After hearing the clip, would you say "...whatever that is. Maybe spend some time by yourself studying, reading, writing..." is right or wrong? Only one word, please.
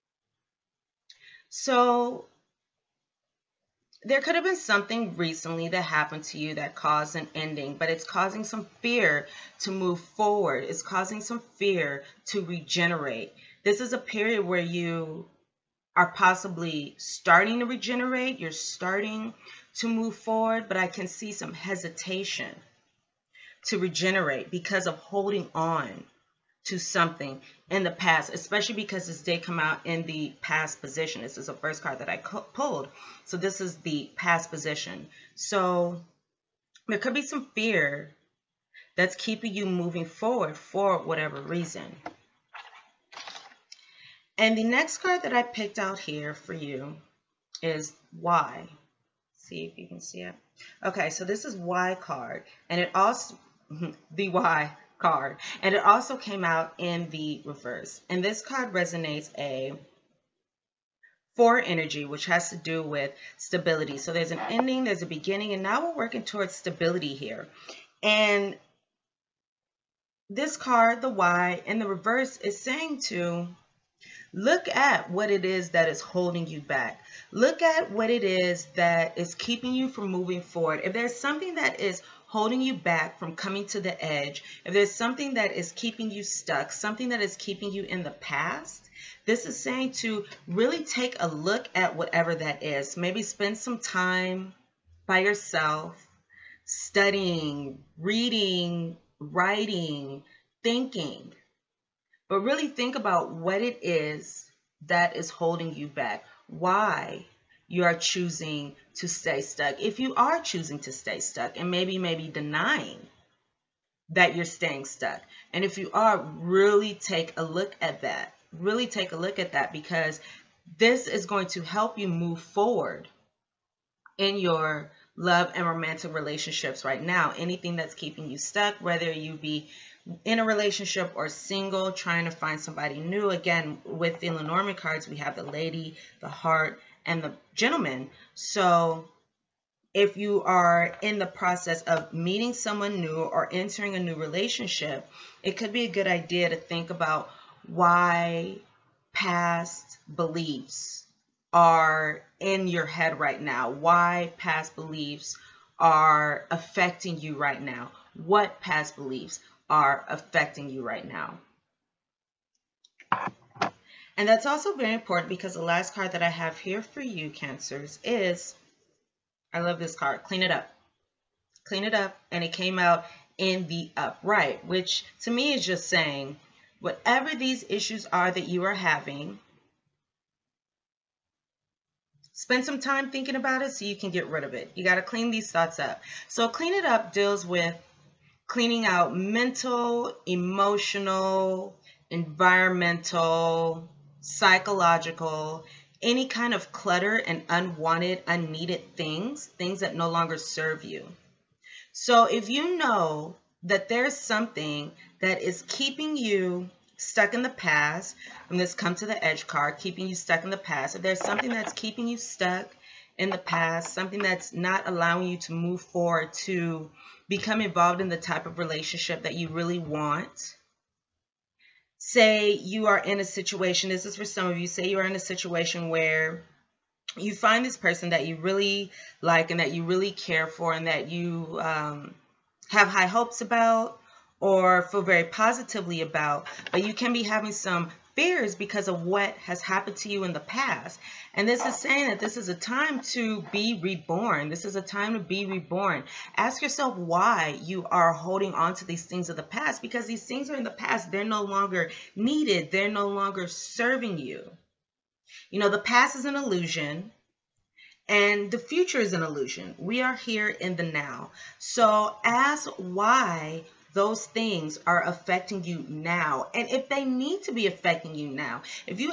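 right.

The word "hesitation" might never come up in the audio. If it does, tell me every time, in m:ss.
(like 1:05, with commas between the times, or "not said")
0:21.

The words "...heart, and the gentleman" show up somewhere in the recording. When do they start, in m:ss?
2:16.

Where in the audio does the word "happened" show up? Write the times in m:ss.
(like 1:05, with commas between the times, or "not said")
0:05, 3:59.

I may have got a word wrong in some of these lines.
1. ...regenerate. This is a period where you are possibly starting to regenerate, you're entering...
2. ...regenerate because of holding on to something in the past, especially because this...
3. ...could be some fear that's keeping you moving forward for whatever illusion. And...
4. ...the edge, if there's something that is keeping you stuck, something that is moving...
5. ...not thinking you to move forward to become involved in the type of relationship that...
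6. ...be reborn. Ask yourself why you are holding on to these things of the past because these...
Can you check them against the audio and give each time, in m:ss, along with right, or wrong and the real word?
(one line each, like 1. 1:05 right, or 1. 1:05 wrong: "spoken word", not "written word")
1. 0:12 wrong: "starting", not "entering"
2. 0:23 right
3. 0:36 wrong: "reason", not "illusion"
4. 1:23 wrong: "keeping", not "moving"
5. 3:34 wrong: "allowing", not "thinking"
6. 4:05 right.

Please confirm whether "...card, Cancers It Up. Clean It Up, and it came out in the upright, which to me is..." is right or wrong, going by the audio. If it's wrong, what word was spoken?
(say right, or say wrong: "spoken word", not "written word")
wrong: "Clean", not "Cancers".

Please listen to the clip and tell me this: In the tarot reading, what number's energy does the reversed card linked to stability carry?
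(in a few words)
4.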